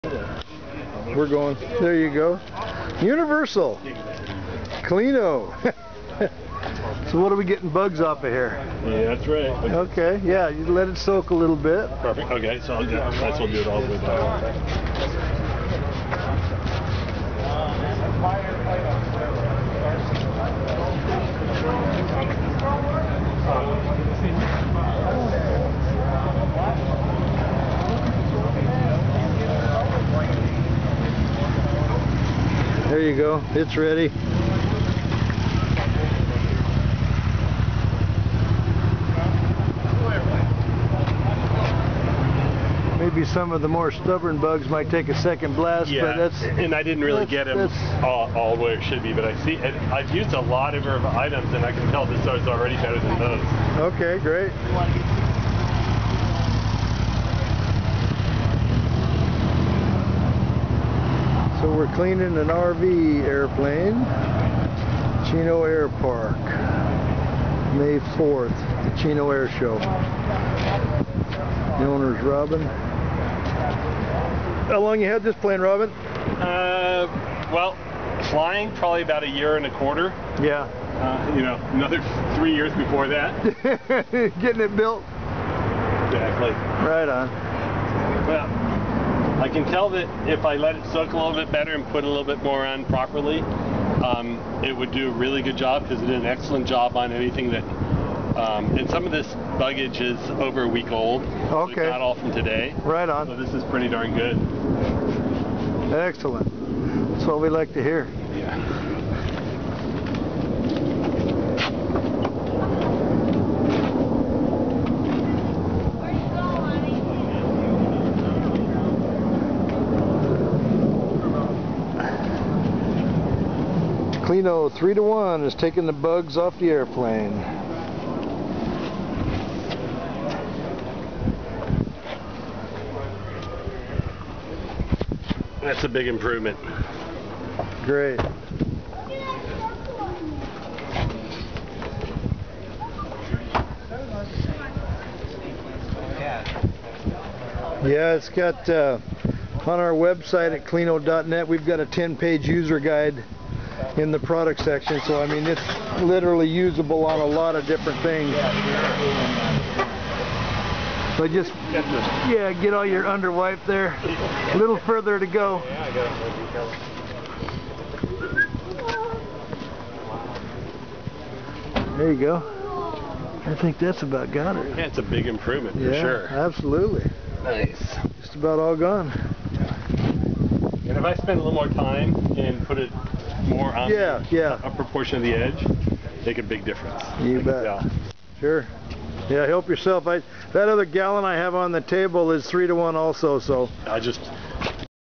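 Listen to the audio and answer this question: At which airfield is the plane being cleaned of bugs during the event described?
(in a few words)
Chino Air Park.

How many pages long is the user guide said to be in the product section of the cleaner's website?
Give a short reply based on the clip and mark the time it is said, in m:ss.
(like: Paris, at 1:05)
10, at 2:31.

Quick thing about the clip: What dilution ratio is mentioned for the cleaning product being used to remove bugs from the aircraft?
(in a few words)
3 to 1.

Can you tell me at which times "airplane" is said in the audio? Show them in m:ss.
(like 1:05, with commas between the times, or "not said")
1:03, 2:06.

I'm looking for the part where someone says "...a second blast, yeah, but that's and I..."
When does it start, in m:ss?
0:45.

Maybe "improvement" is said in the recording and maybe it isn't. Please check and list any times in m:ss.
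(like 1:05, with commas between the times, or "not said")
2:16, 2:55.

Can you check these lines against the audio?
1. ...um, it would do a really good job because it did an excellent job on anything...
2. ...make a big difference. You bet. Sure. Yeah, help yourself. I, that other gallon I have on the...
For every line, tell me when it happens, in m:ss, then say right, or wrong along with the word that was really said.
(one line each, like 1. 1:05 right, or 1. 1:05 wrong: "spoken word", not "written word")
1. 1:34 right
2. 3:06 right.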